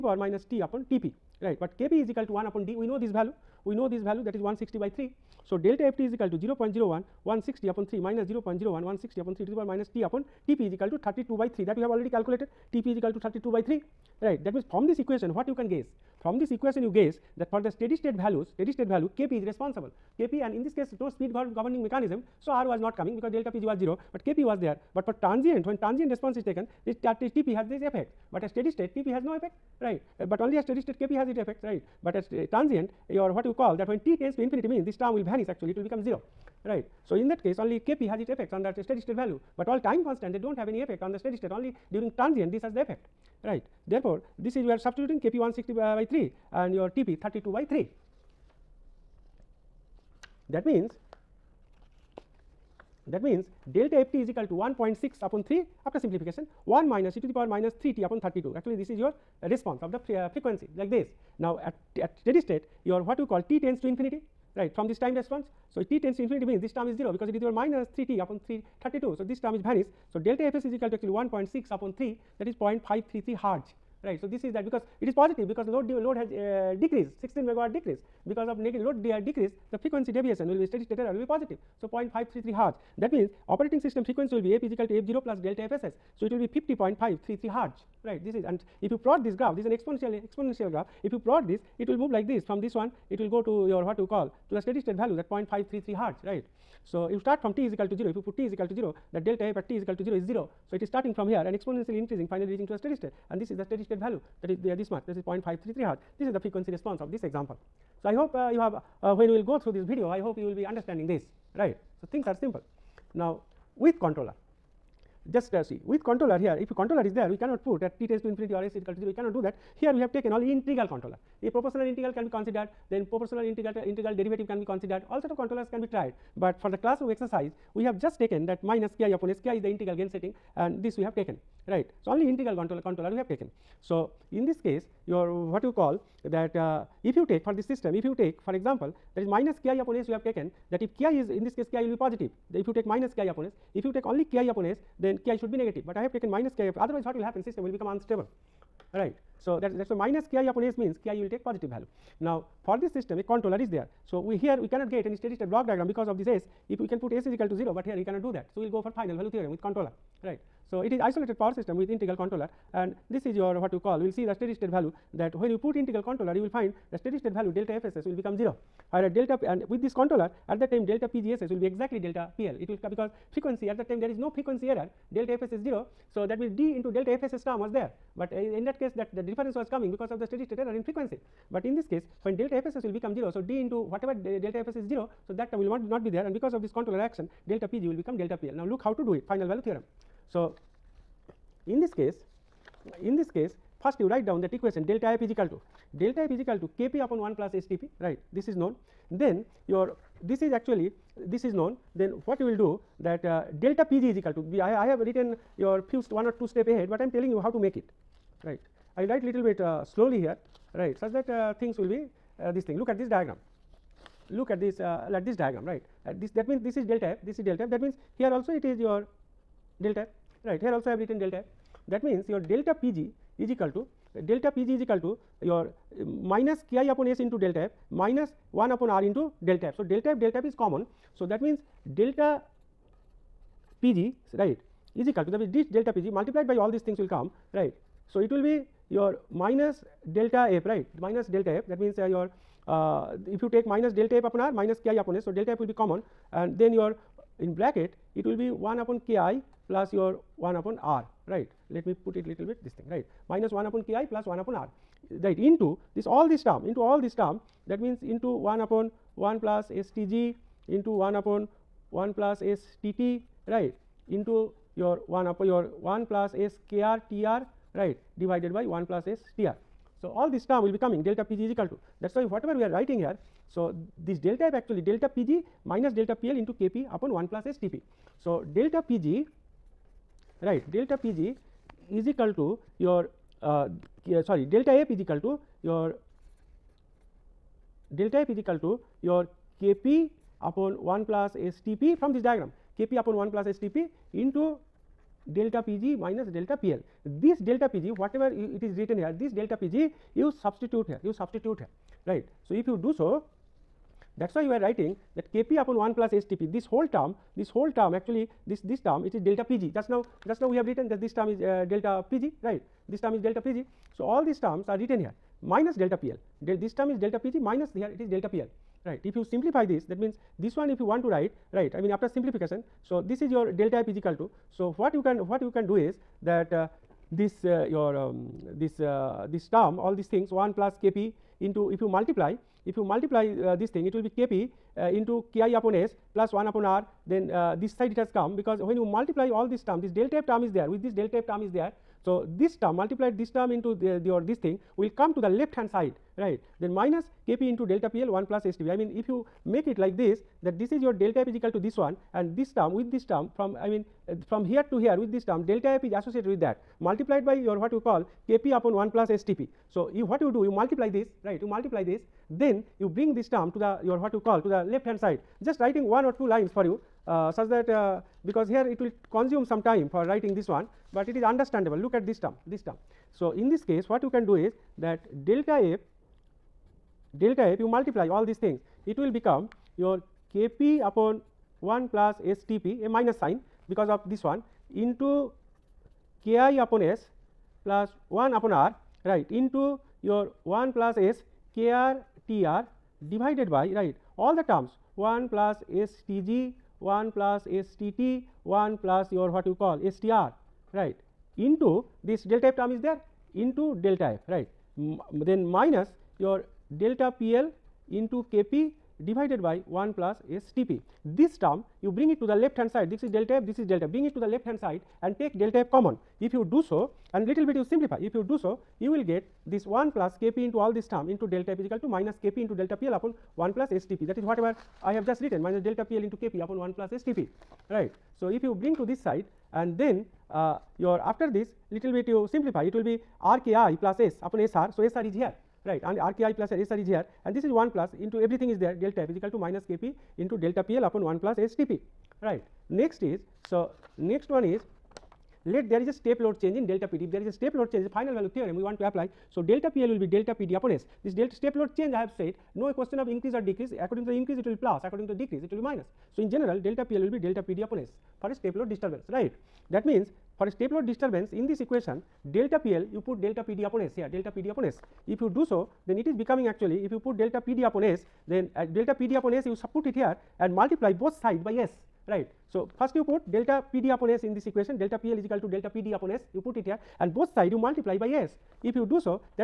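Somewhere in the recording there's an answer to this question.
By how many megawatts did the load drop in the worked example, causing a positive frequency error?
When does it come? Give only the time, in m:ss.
1:17.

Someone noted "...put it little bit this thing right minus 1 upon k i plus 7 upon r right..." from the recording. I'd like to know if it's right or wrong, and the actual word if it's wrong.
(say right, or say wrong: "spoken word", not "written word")
wrong: "1", not "7".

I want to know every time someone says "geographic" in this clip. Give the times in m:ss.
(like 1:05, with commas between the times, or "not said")
not said.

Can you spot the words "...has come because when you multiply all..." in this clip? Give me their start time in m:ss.
5:37.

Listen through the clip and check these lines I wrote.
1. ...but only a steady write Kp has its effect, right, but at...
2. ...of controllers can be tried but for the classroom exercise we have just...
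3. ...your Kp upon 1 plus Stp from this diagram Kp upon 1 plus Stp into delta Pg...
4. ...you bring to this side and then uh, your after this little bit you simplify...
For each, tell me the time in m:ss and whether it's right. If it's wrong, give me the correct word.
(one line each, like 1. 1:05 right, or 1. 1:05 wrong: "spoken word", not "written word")
1. 0:30 wrong: "state", not "write"
2. 2:05 right
3. 4:49 right
4. 7:08 right.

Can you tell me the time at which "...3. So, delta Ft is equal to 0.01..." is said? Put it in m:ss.
0:04.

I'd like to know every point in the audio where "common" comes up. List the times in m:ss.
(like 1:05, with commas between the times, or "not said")
3:50, 4:05, 6:55.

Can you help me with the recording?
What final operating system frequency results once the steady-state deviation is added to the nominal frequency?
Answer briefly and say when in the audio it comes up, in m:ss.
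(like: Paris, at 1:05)
50.533 hertz, at 1:26.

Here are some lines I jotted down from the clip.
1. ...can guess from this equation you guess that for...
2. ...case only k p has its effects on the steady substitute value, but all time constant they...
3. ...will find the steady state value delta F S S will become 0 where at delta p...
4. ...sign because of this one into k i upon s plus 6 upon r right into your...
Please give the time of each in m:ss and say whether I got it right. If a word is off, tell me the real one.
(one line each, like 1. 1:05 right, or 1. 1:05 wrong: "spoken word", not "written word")
1. 0:15 right
2. 0:37 wrong: "state", not "substitute"
3. 2:46 right
4. 6:23 wrong: "1", not "6".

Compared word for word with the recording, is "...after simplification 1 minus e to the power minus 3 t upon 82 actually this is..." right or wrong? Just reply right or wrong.
wrong.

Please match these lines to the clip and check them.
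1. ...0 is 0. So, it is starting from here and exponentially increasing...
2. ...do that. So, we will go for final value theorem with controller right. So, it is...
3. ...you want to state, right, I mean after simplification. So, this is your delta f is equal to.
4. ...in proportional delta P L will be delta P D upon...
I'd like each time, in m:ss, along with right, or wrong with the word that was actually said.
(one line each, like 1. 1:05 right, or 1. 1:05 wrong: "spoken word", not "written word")
1. 1:40 right
2. 2:38 right
3. 5:20 wrong: "write", not "state"
4. 7:36 wrong: "general", not "proportional".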